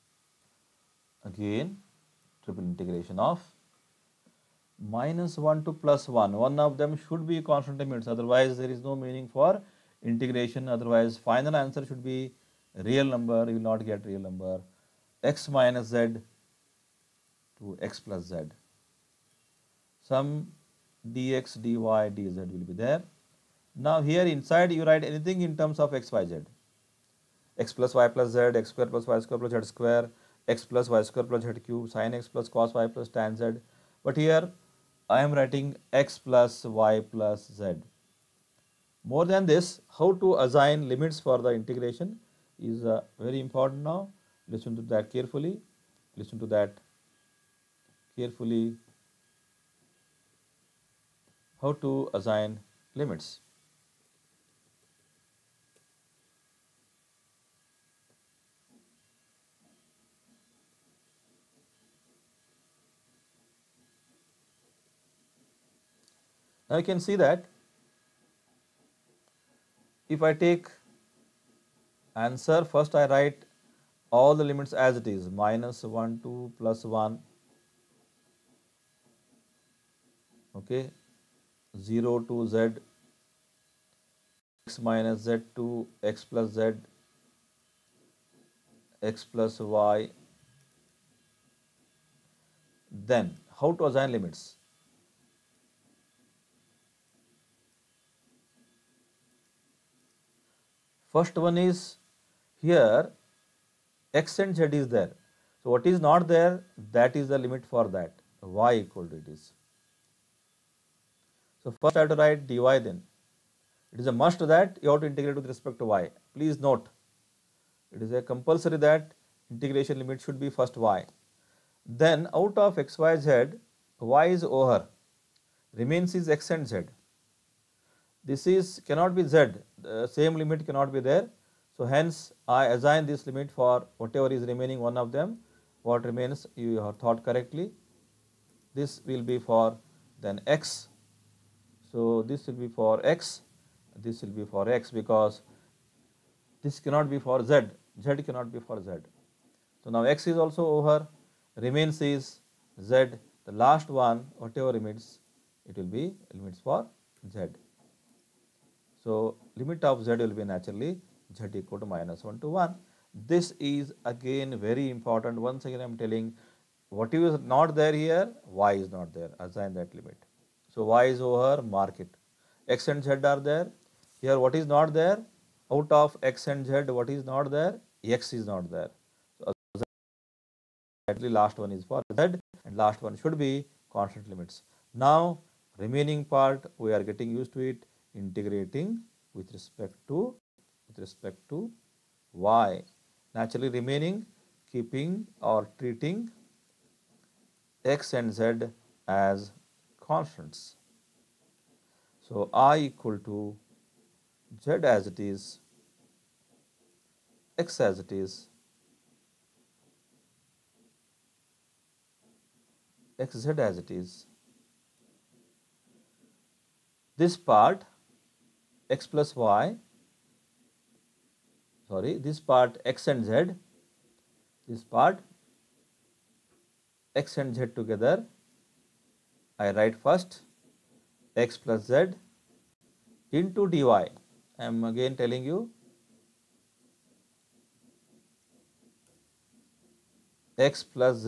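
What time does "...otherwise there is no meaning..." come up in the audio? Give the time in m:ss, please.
0:08.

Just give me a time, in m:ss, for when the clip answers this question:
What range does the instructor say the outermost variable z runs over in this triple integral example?
2:41.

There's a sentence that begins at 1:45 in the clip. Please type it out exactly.
So, what is not there that is the limit for that y equal to it is.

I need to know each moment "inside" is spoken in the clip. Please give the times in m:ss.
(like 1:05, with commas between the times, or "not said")
0:24.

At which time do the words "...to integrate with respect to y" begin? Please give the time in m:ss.
1:55.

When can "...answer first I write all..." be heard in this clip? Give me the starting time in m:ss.
1:12.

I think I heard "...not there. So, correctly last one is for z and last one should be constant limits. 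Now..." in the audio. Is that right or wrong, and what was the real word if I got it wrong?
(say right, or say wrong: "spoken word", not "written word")
wrong: "exactly", not "correctly".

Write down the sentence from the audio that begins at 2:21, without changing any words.
So this will be for x, this will be for x because this cannot be for z, z cannot be for z.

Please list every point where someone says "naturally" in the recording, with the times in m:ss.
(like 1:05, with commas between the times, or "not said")
2:40, 3:13.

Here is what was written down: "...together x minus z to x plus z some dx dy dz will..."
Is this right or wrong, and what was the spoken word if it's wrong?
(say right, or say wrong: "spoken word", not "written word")
wrong: "number", not "together".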